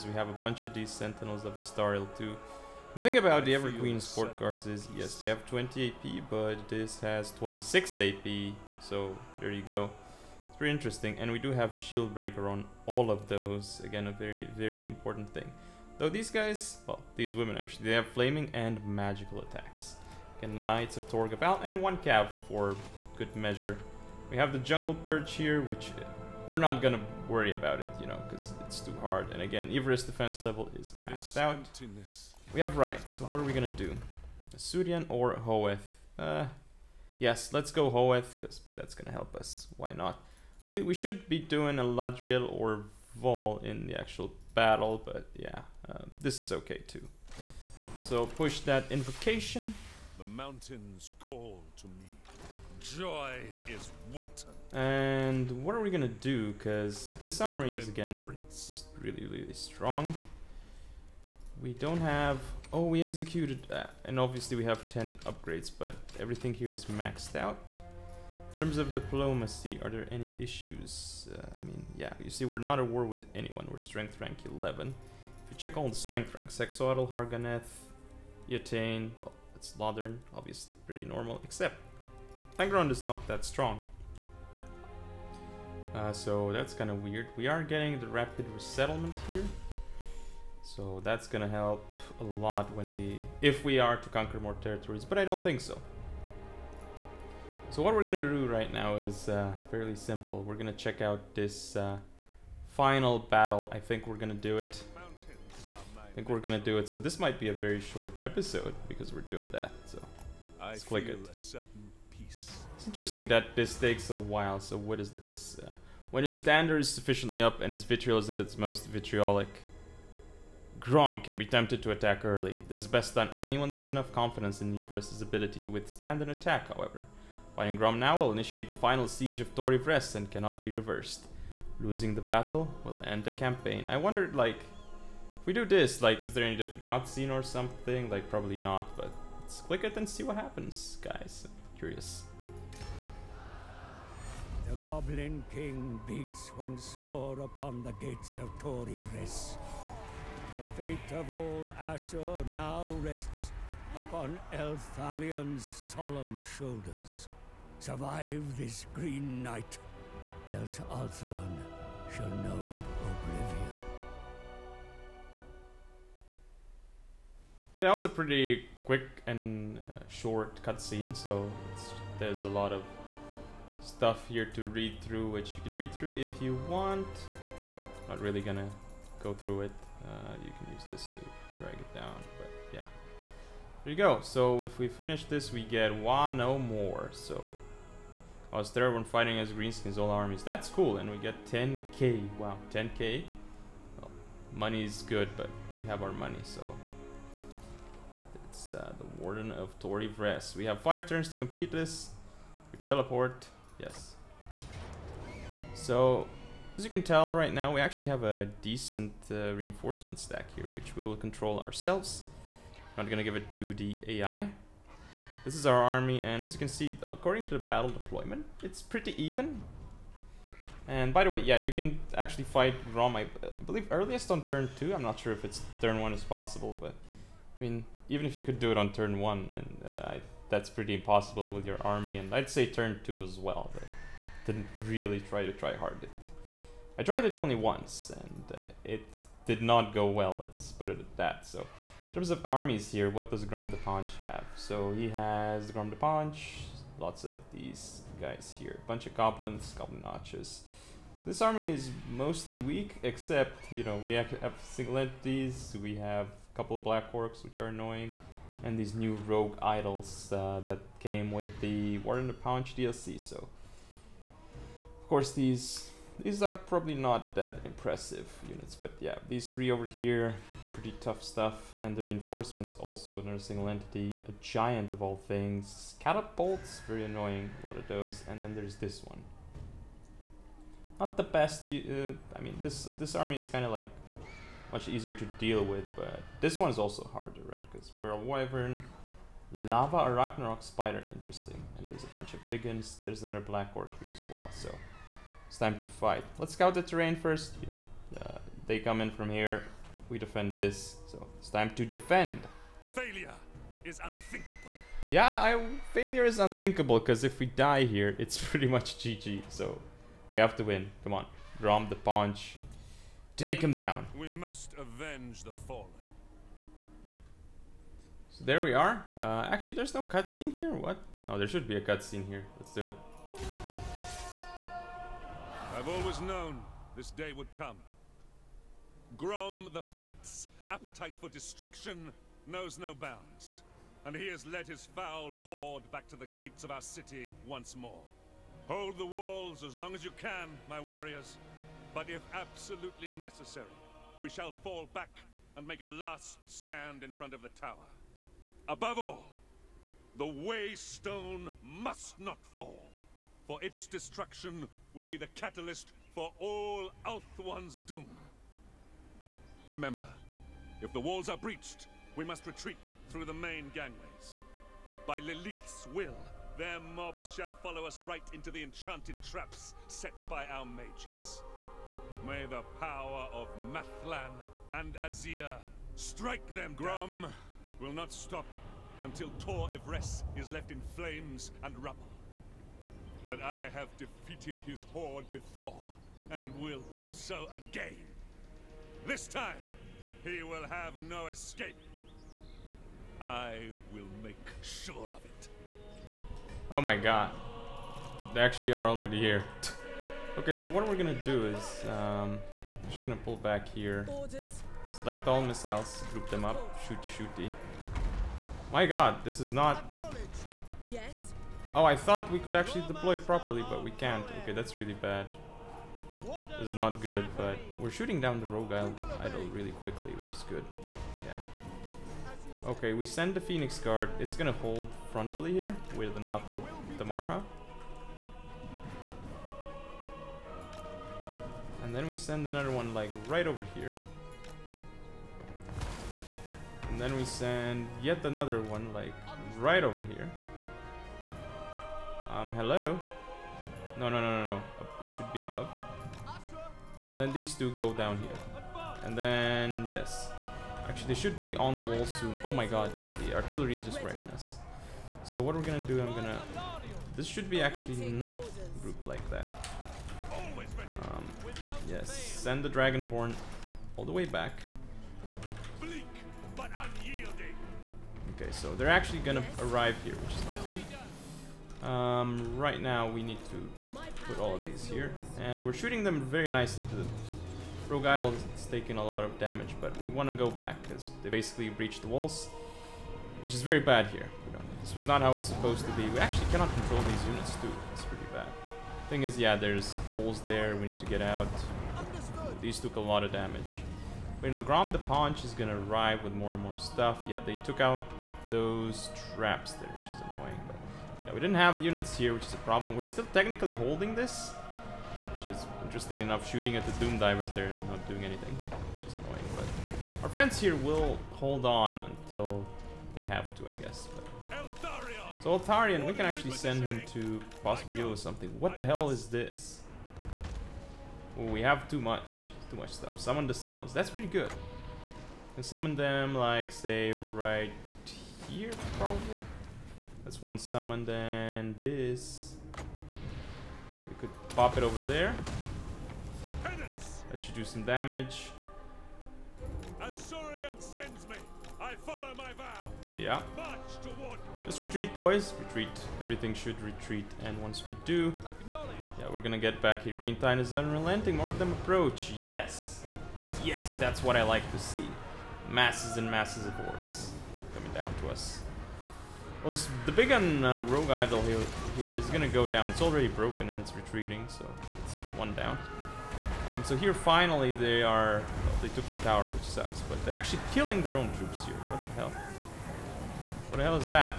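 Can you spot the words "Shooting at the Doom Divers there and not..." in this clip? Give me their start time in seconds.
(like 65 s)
506 s.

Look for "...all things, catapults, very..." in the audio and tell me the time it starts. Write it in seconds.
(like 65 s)
275 s.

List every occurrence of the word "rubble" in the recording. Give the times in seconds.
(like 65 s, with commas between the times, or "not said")
381 s.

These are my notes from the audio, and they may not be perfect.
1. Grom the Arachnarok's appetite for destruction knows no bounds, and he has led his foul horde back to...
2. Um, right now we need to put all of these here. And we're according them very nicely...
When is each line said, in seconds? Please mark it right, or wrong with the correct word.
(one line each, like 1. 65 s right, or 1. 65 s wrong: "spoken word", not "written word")
1. 329 s wrong: "Fat", not "Arachnarok"
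2. 471 s wrong: "shooting", not "according".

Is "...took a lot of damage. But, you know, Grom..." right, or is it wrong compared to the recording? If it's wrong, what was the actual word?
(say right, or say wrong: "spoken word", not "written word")
right.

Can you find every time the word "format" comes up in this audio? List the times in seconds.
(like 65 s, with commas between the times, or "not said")
not said.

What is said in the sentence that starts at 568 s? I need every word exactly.
Well, they took the tower, which sucks, but they're actually killing their own troops here.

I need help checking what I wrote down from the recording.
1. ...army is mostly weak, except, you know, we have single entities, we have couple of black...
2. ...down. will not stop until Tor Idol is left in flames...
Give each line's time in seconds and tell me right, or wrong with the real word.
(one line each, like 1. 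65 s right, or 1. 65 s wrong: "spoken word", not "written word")
1. 251 s right
2. 377 s wrong: "Yvresse", not "Idol".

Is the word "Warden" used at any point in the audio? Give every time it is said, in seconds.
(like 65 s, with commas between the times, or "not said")
199 s, 261 s.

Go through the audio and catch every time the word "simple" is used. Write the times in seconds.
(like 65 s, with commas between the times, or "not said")
99 s.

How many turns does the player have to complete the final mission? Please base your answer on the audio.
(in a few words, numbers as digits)
5.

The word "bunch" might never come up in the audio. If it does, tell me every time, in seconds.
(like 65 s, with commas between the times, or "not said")
0 s, 248 s, 292 s.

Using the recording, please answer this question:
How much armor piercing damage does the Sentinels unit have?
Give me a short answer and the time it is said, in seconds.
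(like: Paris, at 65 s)
26, at 7 s.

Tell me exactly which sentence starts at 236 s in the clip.
I tried it only once, and uh, it did not go well.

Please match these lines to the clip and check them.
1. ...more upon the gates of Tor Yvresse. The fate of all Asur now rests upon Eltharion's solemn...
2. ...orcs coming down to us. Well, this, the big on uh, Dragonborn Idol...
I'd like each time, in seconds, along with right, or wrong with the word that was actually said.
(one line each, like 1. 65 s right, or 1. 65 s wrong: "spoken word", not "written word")
1. 147 s right
2. 556 s wrong: "Rogue", not "Dragonborn".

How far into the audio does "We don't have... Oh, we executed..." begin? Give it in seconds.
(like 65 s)
61 s.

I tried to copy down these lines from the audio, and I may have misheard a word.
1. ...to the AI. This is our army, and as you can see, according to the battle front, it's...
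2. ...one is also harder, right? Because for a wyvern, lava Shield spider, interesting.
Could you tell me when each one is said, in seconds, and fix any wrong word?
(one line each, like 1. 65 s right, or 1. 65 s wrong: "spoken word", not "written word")
1. 213 s wrong: "deployment", not "front"
2. 286 s wrong: "Arachnarok", not "Shield".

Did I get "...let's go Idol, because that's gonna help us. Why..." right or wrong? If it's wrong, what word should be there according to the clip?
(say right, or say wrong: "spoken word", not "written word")
wrong: "Hoeth", not "Idol".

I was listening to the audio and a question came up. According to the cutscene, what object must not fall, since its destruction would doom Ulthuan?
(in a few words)
the Waystone.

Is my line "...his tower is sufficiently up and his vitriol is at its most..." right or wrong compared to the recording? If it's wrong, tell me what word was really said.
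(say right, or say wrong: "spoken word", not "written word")
wrong: "dander", not "tower".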